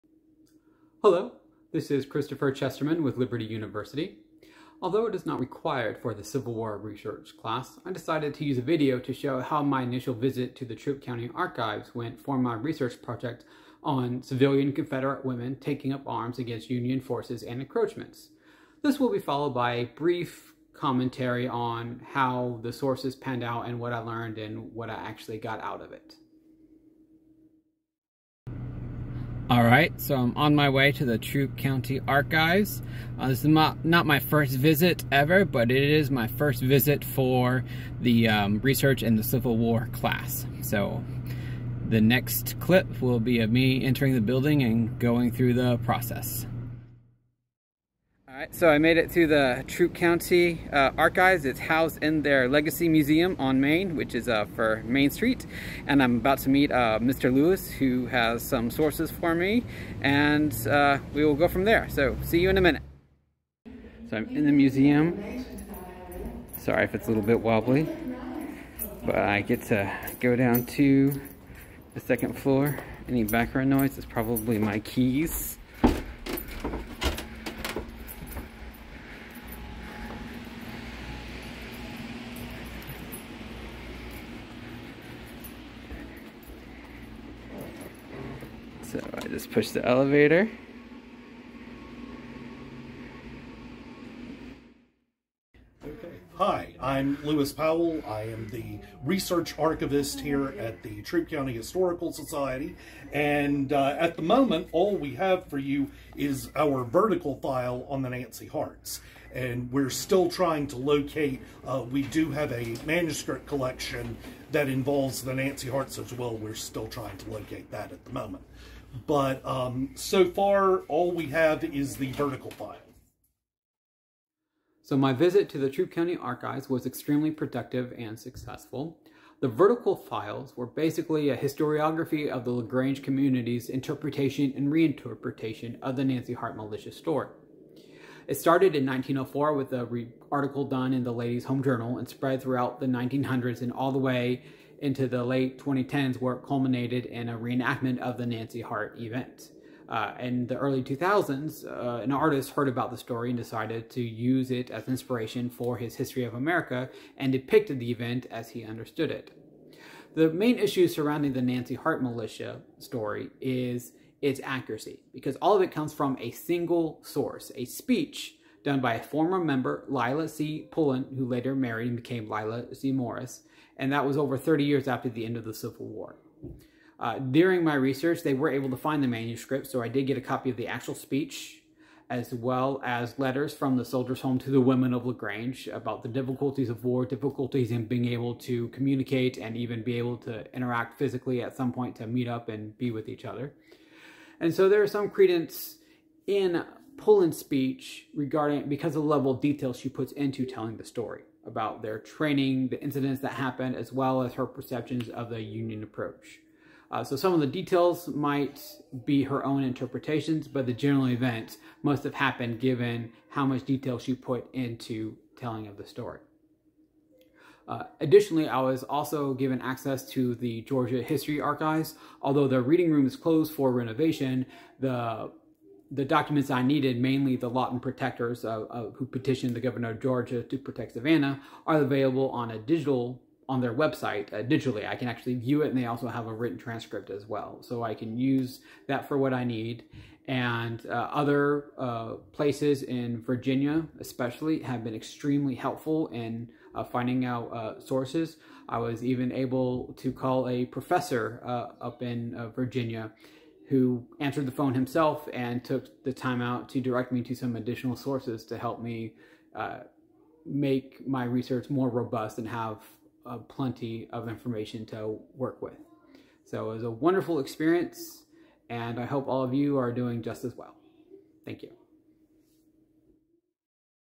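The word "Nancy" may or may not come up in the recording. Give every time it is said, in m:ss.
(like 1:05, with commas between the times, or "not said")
1:48, 1:55, 2:16, 2:28, 2:41.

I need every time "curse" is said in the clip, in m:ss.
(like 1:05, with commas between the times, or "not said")
not said.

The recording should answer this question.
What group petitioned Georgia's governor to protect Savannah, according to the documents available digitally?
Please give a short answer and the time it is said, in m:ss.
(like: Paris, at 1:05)
Lawton protectors, at 3:47.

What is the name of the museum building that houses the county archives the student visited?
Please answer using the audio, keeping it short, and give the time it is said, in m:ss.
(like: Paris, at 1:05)
Legacy Museum on Main, at 0:52.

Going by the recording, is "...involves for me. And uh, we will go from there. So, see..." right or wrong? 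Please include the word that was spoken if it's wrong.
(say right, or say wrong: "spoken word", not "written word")
wrong: "sources", not "involves".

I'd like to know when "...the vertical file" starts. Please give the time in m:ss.
2:01.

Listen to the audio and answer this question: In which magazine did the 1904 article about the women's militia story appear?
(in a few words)
Ladies' Home Journal.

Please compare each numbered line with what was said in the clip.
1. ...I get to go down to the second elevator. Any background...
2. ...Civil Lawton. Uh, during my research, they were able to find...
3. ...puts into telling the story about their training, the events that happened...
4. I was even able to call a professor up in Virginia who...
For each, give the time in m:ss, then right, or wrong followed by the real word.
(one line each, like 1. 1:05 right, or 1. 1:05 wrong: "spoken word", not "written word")
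1. 1:09 wrong: "floor", not "elevator"
2. 2:55 wrong: "War", not "Lawton"
3. 3:19 wrong: "incidents", not "events"
4. 4:08 right.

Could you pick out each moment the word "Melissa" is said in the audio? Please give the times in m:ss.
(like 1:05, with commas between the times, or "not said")
not said.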